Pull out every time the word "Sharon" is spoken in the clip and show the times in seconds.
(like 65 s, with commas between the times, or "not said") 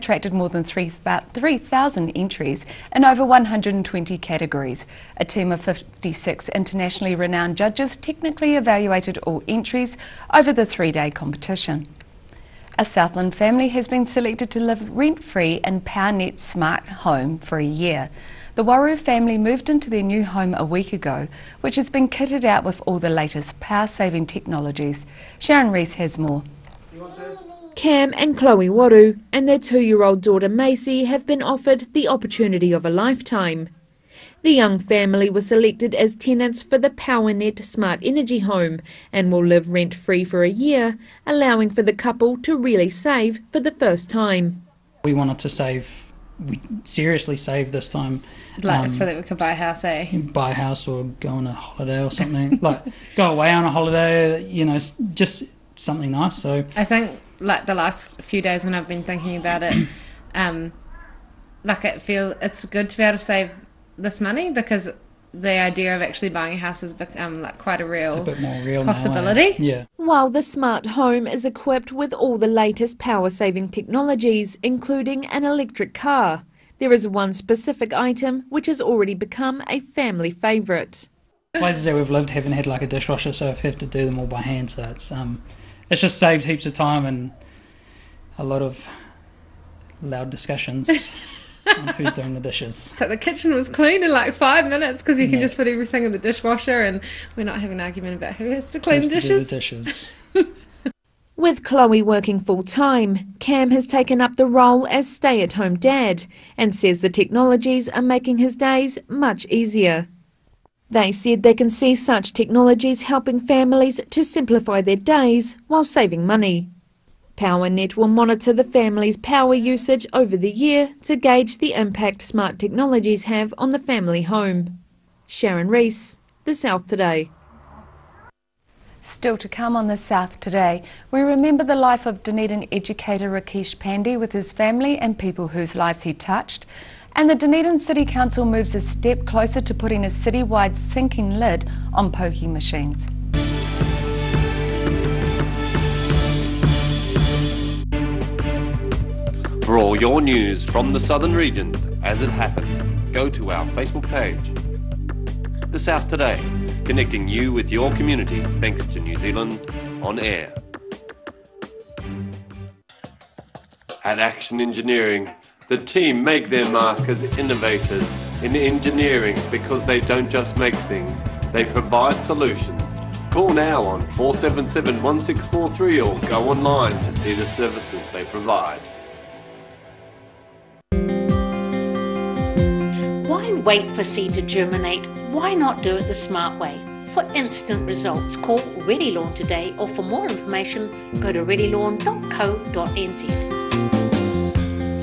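25 s, 125 s.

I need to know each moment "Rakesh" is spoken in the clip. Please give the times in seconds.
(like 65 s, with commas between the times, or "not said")
133 s.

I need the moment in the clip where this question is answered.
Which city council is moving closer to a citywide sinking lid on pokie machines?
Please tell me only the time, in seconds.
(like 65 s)
137 s.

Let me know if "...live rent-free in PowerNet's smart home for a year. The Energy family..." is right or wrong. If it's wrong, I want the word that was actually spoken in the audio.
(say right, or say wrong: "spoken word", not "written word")
wrong: "Waru", not "Energy".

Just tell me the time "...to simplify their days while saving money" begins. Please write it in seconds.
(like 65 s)
114 s.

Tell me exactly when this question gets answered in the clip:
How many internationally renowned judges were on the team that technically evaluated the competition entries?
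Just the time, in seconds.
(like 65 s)
5 s.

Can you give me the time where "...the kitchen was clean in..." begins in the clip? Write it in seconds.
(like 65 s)
93 s.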